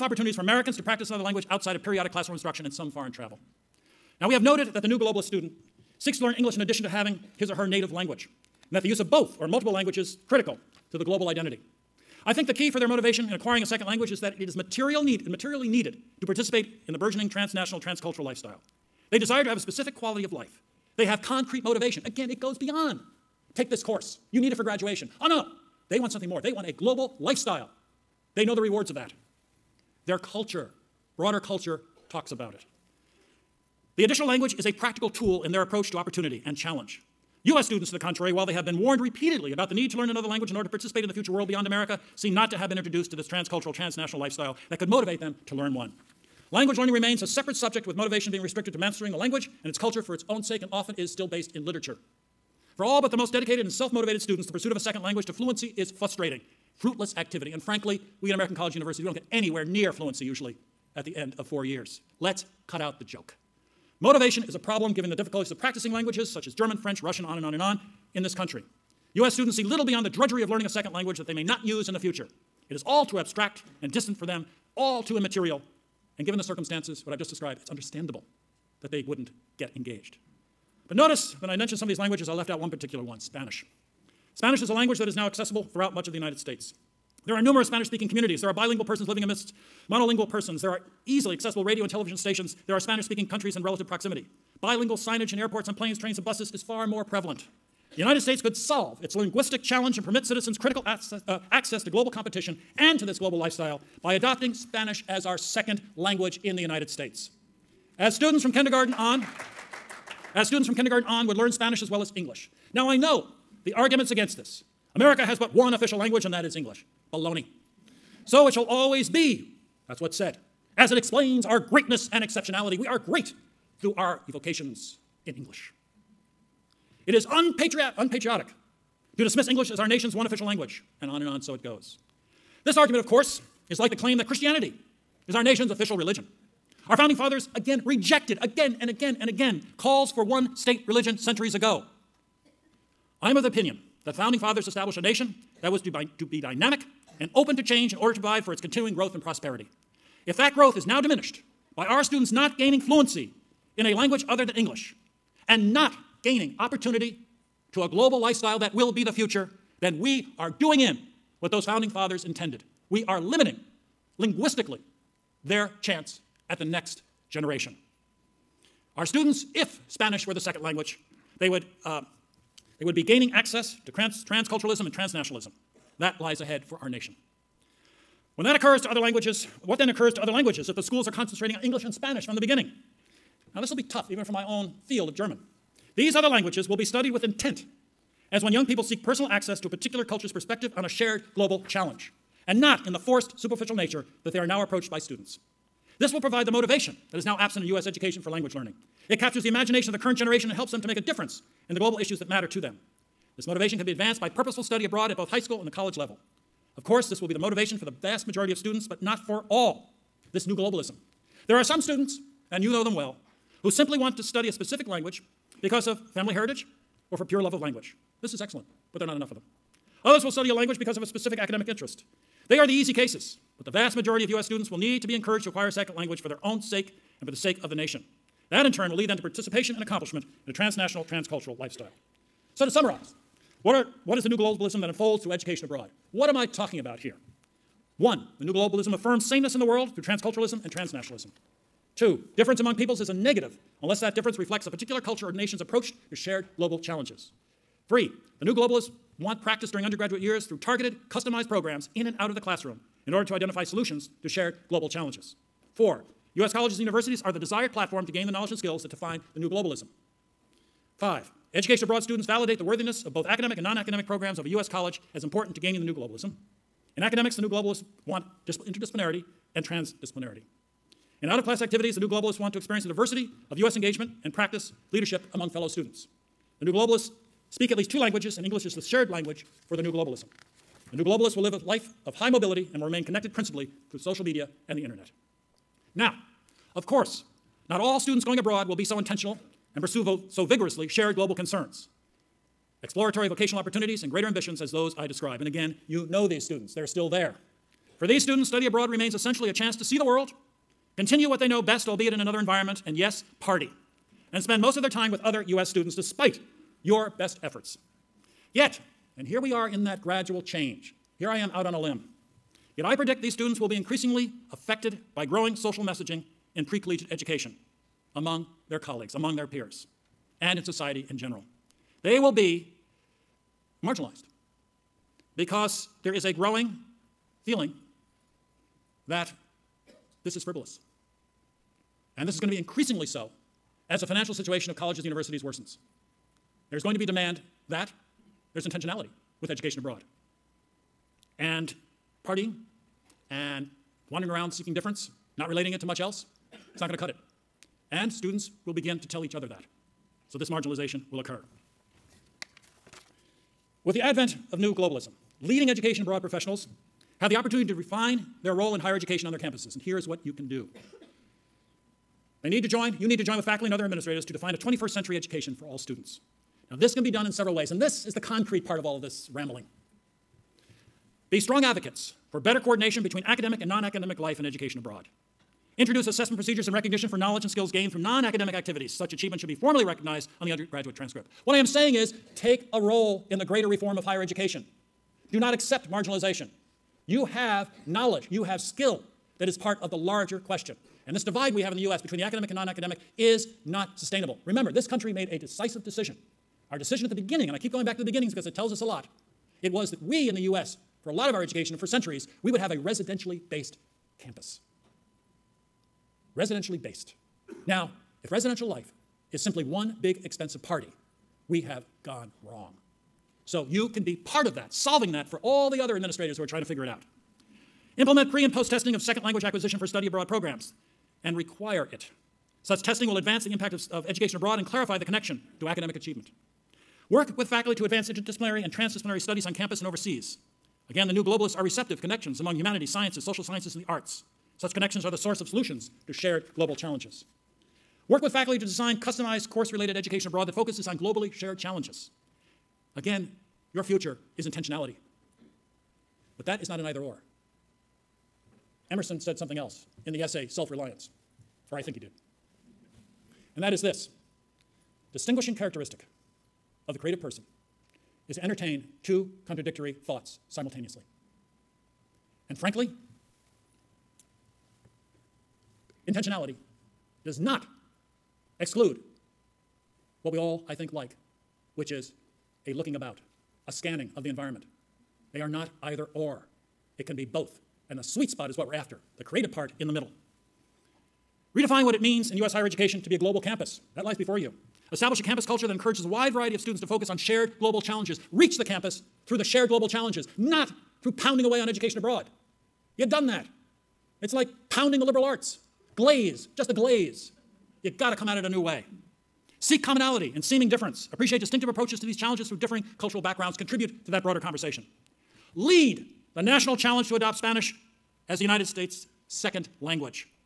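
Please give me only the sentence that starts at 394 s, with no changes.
Remember, this country made a decisive decision.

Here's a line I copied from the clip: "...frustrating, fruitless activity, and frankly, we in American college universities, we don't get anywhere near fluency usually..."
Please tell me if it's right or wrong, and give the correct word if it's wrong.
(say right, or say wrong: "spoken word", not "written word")
right.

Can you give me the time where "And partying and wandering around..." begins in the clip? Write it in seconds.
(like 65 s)
341 s.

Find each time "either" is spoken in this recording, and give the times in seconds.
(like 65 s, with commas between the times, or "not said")
446 s, 475 s.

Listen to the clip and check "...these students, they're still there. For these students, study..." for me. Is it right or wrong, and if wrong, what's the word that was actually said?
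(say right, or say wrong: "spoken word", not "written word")
right.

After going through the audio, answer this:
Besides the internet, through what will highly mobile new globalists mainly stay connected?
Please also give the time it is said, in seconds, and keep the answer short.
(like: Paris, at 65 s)
social media, at 283 s.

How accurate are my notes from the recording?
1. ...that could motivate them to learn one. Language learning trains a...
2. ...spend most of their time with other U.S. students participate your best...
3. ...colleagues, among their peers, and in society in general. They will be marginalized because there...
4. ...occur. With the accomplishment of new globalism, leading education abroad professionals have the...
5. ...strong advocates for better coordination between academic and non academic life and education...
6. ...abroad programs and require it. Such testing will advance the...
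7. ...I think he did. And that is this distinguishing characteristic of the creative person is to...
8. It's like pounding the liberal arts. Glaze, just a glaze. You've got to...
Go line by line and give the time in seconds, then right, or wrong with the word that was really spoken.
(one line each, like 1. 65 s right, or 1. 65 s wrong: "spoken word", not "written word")
1. 44 s wrong: "remains", not "trains"
2. 304 s wrong: "despite", not "participate"
3. 318 s right
4. 351 s wrong: "advent", not "accomplishment"
5. 371 s right
6. 420 s right
7. 451 s right
8. 494 s right.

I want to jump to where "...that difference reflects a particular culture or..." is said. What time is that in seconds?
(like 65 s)
243 s.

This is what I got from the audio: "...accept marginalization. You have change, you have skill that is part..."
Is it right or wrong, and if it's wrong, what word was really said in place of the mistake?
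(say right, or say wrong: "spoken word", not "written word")
wrong: "knowledge", not "change".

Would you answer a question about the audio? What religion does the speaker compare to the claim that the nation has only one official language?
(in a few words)
Christianity.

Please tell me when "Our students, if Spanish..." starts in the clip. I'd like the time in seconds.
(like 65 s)
168 s.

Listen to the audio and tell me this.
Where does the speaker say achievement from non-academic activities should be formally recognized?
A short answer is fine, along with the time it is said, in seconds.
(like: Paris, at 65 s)
the undergraduate transcript, at 380 s.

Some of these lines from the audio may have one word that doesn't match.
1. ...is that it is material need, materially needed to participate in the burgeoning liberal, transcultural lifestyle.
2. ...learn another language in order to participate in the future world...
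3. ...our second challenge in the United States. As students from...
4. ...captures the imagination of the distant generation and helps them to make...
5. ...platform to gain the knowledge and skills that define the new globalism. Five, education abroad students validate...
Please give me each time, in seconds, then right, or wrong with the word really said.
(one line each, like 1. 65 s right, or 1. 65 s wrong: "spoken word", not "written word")
1. 14 s wrong: "transnational", not "liberal"
2. 39 s right
3. 105 s wrong: "language", not "challenge"
4. 199 s wrong: "current", not "distant"
5. 257 s right.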